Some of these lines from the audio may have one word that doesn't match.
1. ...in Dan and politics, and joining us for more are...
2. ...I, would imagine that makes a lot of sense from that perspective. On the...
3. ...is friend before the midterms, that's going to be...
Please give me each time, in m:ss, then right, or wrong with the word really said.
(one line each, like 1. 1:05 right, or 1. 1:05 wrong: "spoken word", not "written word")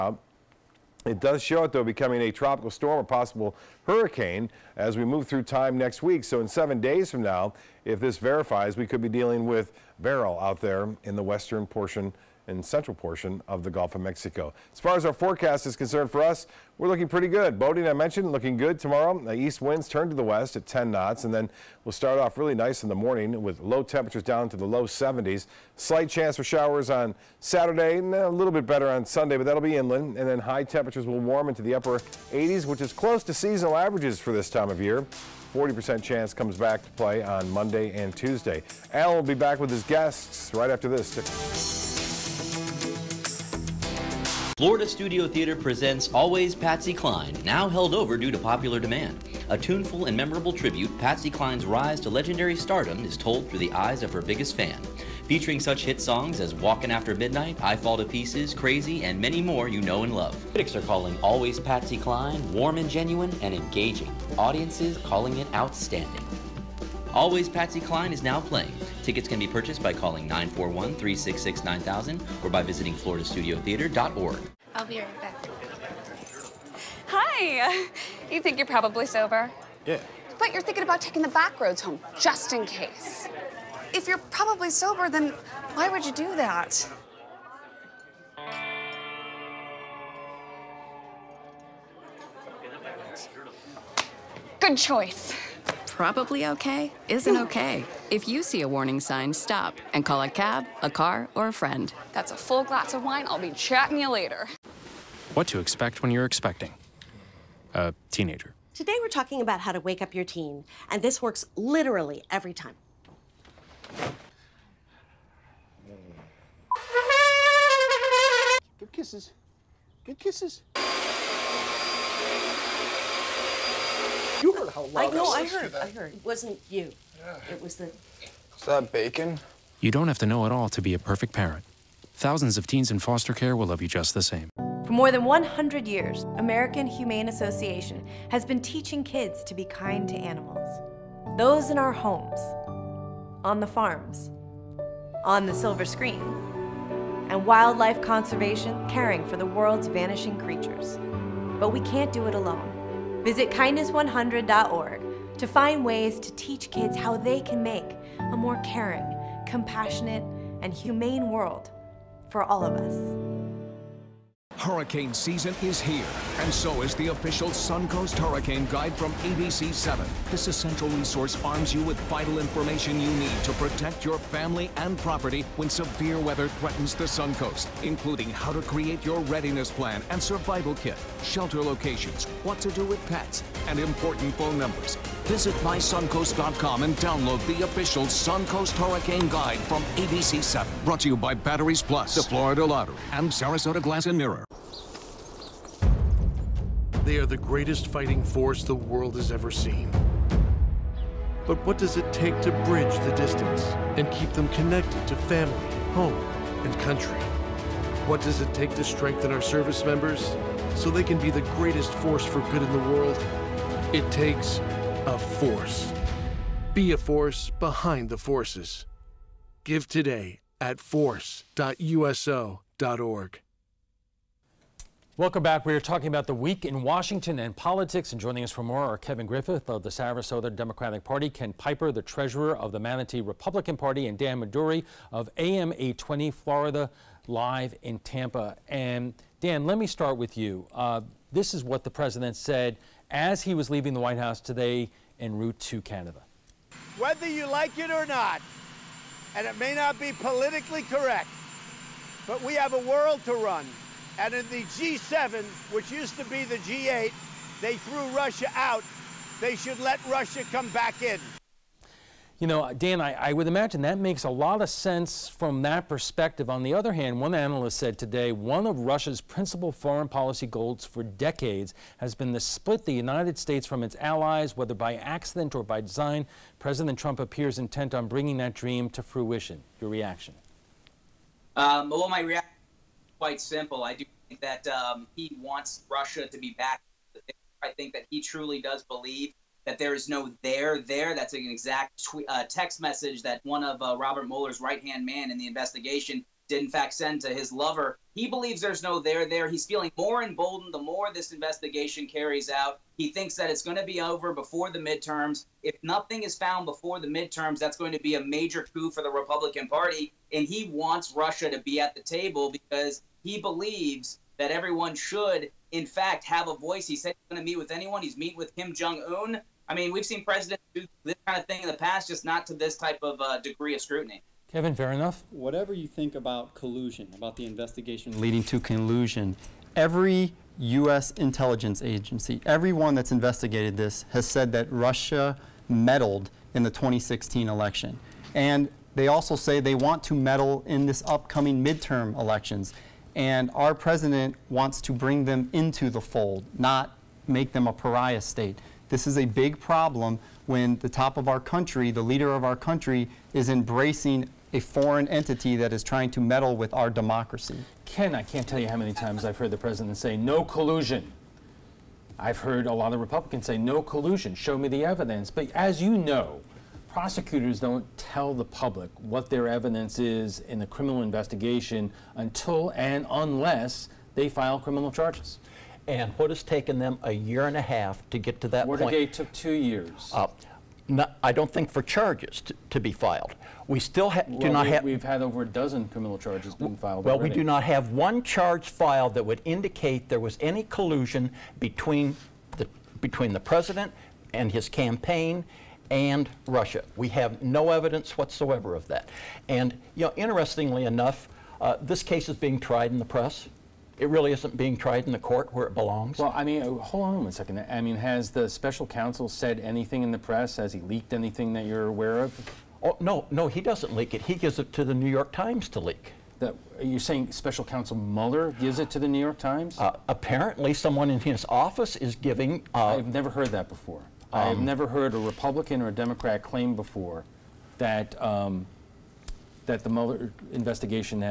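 1. 3:46 wrong: "Washington", not "Dan"
2. 4:23 right
3. 5:06 wrong: "found", not "friend".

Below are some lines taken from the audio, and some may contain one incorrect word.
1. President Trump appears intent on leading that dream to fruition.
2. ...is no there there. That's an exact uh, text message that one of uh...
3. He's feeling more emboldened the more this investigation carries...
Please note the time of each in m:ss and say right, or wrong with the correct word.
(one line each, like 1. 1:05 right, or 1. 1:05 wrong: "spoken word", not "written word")
1. 4:36 wrong: "bringing", not "leading"
2. 4:49 right
3. 4:59 right.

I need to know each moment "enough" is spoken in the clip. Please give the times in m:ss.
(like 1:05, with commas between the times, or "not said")
5:24, 6:40.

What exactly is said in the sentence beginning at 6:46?
Well, I mean, oh, hold on a second.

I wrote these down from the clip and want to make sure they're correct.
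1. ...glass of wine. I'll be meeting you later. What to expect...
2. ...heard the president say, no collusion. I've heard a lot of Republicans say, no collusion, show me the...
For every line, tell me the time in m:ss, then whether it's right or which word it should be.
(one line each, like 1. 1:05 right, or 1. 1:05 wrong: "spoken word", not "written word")
1. 1:42 wrong: "chatting", not "meeting"
2. 5:59 right.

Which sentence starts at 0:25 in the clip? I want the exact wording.
Slight chance for showers on Saturday, and a little bit better on Sunday, but that'll be inland.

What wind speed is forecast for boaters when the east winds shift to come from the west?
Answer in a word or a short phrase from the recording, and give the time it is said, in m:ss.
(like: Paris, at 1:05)
10 knots, at 0:20.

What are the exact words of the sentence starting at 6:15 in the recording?
And what has taken them a year and a half to get to that Watergate point?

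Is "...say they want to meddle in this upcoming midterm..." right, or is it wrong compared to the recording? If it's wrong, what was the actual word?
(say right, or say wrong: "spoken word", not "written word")
right.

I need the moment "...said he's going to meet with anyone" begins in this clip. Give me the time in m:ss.
5:16.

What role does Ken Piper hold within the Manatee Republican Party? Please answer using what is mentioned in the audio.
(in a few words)
treasurer.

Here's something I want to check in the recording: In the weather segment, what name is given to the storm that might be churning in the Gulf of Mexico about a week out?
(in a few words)
Beryl.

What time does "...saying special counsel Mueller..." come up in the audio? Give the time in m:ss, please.
6:56.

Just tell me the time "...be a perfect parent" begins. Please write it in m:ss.
2:10.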